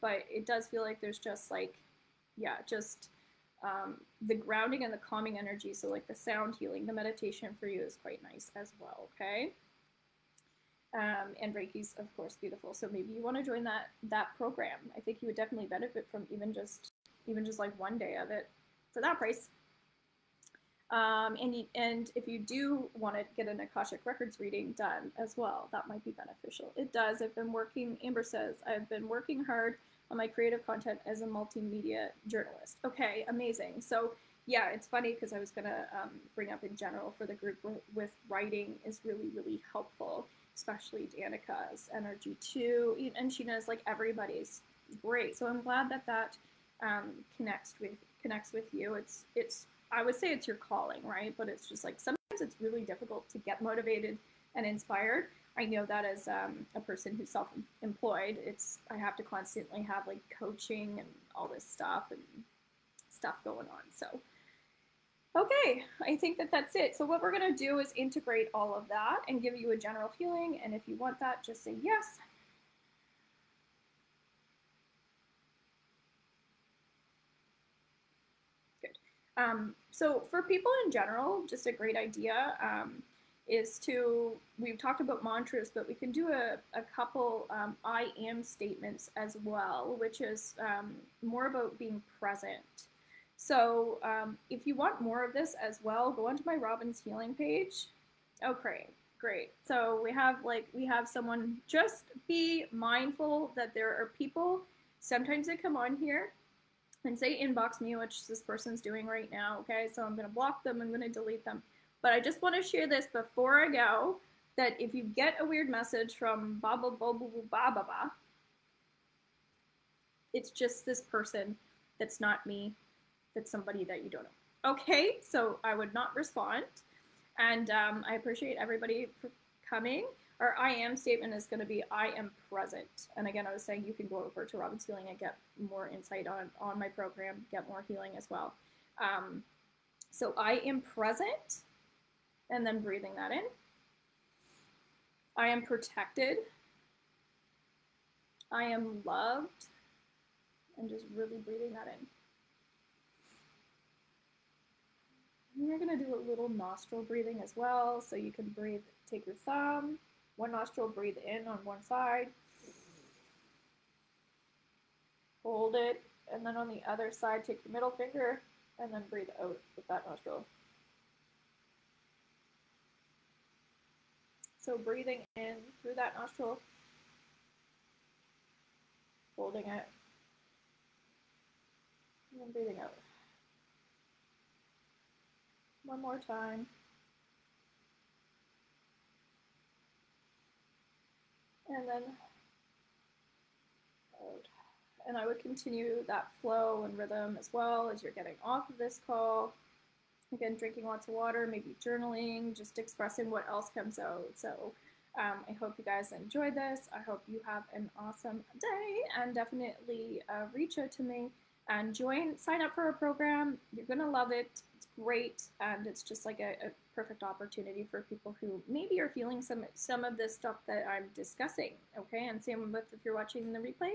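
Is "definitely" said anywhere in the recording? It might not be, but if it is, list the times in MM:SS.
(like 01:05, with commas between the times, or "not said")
00:15, 03:29.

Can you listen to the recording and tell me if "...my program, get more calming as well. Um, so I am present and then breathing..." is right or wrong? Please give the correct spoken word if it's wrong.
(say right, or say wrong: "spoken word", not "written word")
wrong: "healing", not "calming".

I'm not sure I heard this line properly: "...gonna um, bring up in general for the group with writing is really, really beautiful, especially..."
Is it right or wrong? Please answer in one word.
wrong.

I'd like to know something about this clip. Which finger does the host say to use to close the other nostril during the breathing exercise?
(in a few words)
middle finger.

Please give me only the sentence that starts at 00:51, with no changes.
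But it's just like sometimes it's really difficult to get motivated and inspired.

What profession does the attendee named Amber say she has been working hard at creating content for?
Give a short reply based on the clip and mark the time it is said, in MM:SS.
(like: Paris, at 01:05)
multimedia journalist, at 00:31.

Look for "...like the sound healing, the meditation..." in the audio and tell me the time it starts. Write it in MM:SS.
00:05.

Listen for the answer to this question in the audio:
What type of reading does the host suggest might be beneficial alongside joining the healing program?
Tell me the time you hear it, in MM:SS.
00:23.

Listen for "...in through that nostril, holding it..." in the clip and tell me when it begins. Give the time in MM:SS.
02:55.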